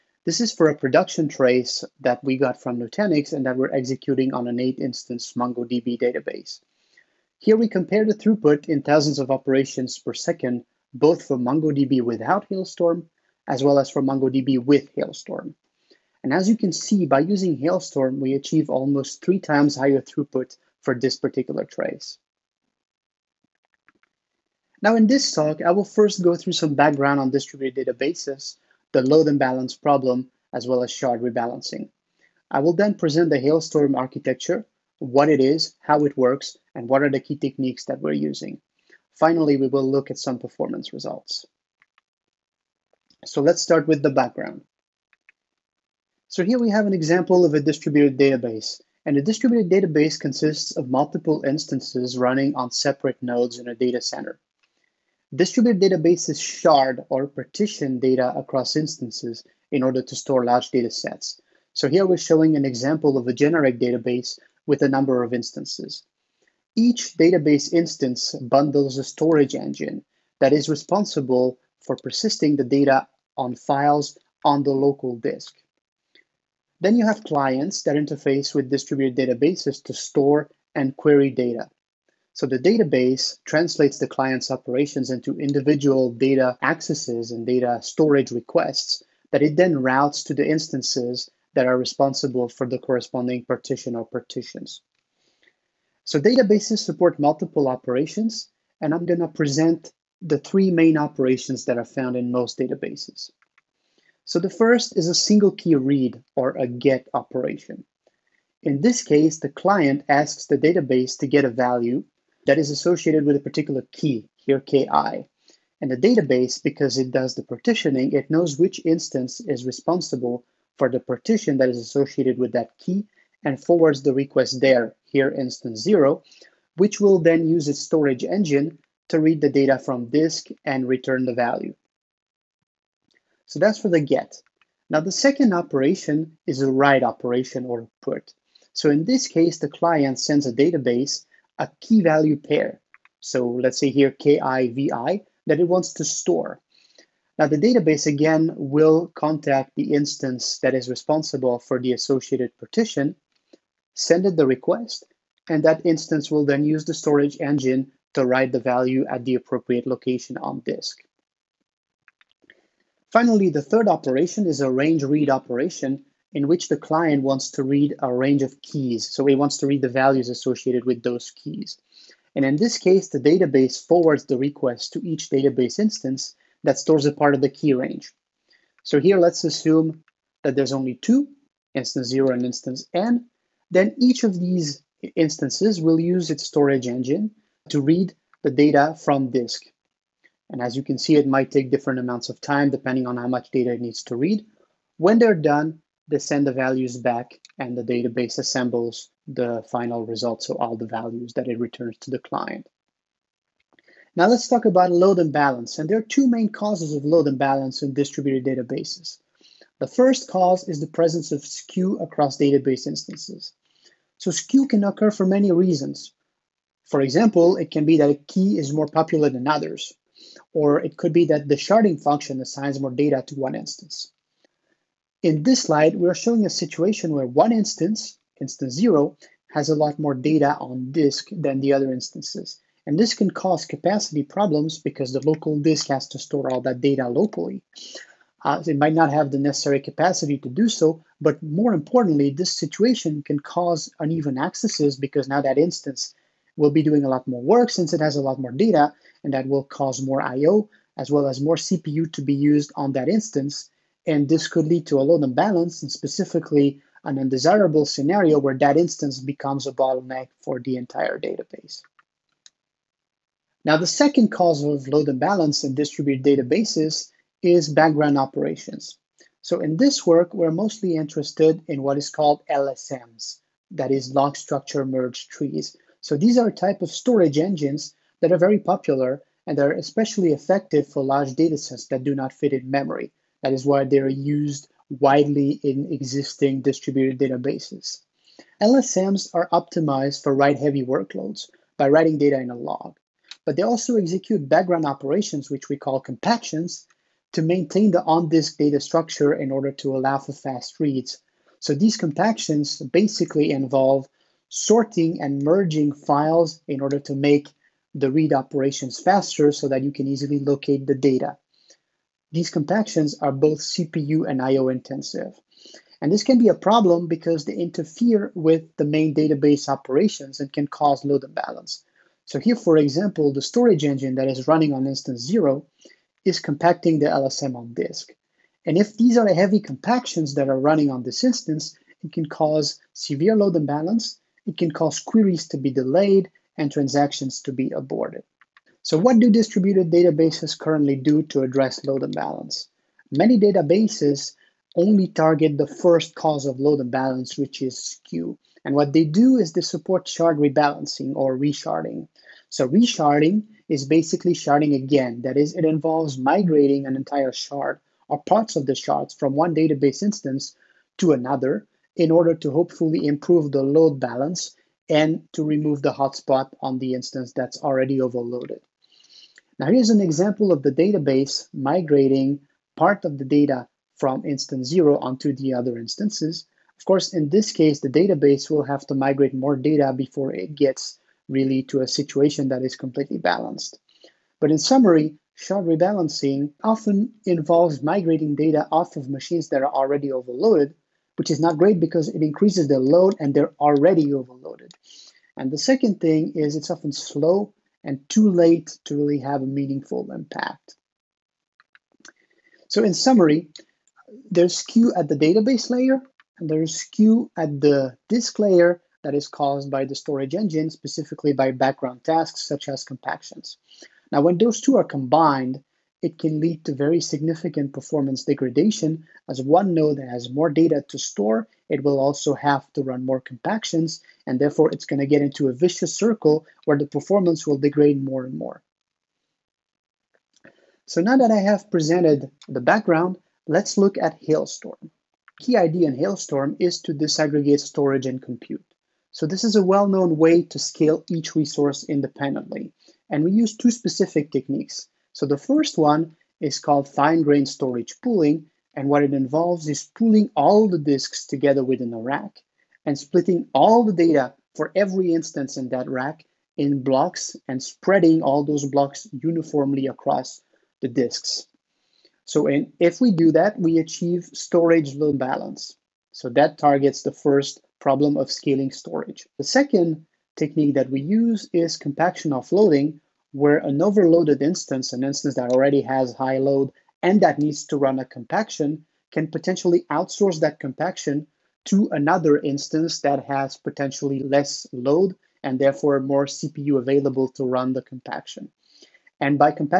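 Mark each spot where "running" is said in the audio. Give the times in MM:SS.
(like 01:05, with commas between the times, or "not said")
00:52, 05:24, 05:30.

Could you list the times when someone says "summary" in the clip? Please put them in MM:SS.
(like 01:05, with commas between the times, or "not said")
06:24, 06:42.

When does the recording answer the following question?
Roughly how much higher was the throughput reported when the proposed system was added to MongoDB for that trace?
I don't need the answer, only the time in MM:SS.
00:18.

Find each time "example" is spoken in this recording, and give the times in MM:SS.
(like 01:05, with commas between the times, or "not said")
00:46, 01:02, 03:36, 05:22, 06:09.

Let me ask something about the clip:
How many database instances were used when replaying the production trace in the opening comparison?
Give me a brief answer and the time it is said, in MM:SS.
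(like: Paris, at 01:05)
8, at 00:04.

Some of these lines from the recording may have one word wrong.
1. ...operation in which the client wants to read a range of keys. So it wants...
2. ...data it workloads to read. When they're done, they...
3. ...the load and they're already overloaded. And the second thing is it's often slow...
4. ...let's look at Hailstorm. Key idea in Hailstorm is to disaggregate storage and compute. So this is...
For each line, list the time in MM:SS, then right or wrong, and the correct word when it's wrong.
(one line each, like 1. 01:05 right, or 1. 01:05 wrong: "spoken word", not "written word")
1. 02:45 right
2. 03:13 wrong: "needs", not "workloads"
3. 06:32 right
4. 07:13 right.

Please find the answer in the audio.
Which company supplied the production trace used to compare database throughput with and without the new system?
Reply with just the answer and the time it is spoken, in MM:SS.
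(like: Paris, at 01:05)
Nutanix, at 00:02.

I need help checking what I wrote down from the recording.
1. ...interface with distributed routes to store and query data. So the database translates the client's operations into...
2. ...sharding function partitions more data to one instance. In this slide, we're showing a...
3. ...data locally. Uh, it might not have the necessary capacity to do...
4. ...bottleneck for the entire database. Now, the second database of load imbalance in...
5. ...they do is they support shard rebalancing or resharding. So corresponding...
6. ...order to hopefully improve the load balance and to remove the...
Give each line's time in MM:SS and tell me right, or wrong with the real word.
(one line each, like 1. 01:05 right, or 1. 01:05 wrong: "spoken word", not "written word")
1. 01:17 wrong: "databases", not "routes"
2. 03:41 wrong: "assigns", not "partitions"
3. 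03:56 right
4. 04:19 wrong: "cause", not "database"
5. 05:48 wrong: "resharding", not "corresponding"
6. 06:02 right.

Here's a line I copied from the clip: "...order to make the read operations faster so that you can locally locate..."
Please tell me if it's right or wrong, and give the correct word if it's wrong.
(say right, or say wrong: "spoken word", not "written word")
wrong: "easily", not "locally".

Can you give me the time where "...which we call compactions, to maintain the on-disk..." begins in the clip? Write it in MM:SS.
04:55.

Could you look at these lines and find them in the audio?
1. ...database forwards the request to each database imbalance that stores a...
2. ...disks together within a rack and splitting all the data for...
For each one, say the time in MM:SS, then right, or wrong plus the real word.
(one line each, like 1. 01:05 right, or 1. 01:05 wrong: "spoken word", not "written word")
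1. 02:53 wrong: "instance", not "imbalance"
2. 07:30 right.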